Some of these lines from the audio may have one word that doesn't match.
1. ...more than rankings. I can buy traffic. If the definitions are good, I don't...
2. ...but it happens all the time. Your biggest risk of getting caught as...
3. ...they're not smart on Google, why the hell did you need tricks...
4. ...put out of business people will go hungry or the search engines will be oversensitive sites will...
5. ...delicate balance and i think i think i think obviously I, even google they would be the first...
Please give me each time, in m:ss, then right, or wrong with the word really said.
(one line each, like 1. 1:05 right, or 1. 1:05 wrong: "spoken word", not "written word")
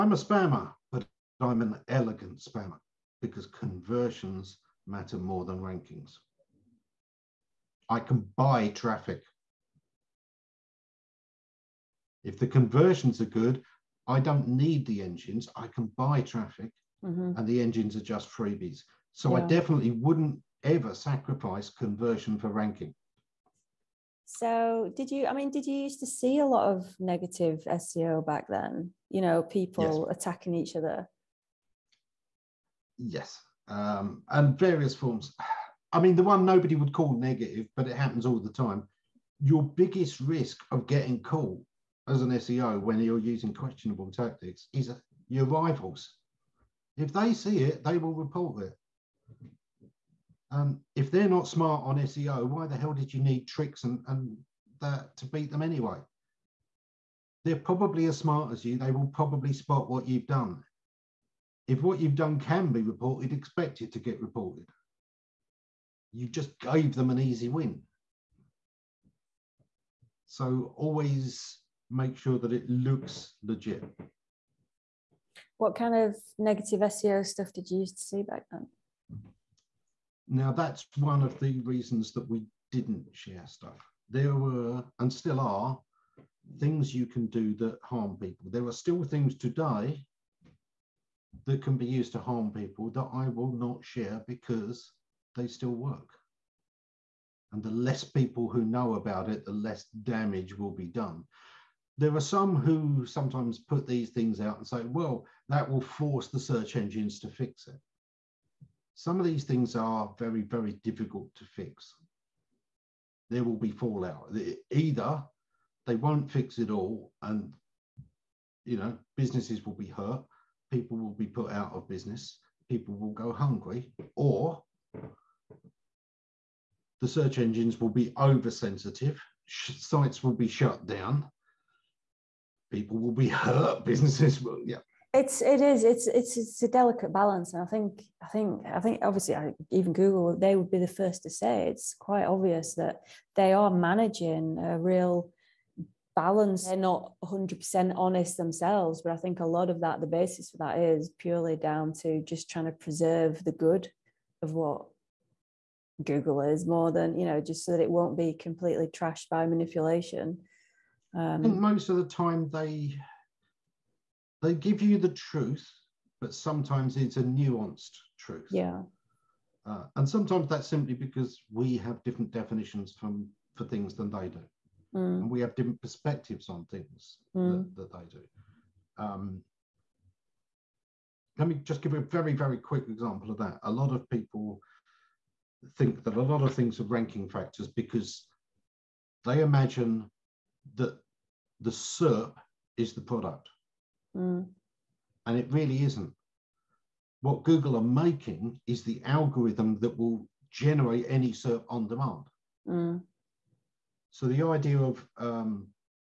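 1. 0:05 wrong: "conversions", not "definitions"
2. 0:37 right
3. 0:51 wrong: "SEO", not "Google"
4. 2:01 right
5. 2:16 right.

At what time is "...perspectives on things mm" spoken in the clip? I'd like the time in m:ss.
2:55.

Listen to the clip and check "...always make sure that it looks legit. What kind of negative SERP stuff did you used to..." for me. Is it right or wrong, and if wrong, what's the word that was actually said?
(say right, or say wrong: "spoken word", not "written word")
wrong: "SEO", not "SERP".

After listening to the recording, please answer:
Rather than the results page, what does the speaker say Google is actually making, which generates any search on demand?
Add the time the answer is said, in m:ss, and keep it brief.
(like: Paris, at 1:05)
the algorithm, at 3:18.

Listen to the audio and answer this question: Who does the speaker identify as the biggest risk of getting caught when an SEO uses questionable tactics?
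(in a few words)
your rivals.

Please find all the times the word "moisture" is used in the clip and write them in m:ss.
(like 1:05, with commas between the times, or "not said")
not said.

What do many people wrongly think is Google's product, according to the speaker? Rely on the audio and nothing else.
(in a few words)
the SERP.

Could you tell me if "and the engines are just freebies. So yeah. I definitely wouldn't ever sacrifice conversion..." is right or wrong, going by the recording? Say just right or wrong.
right.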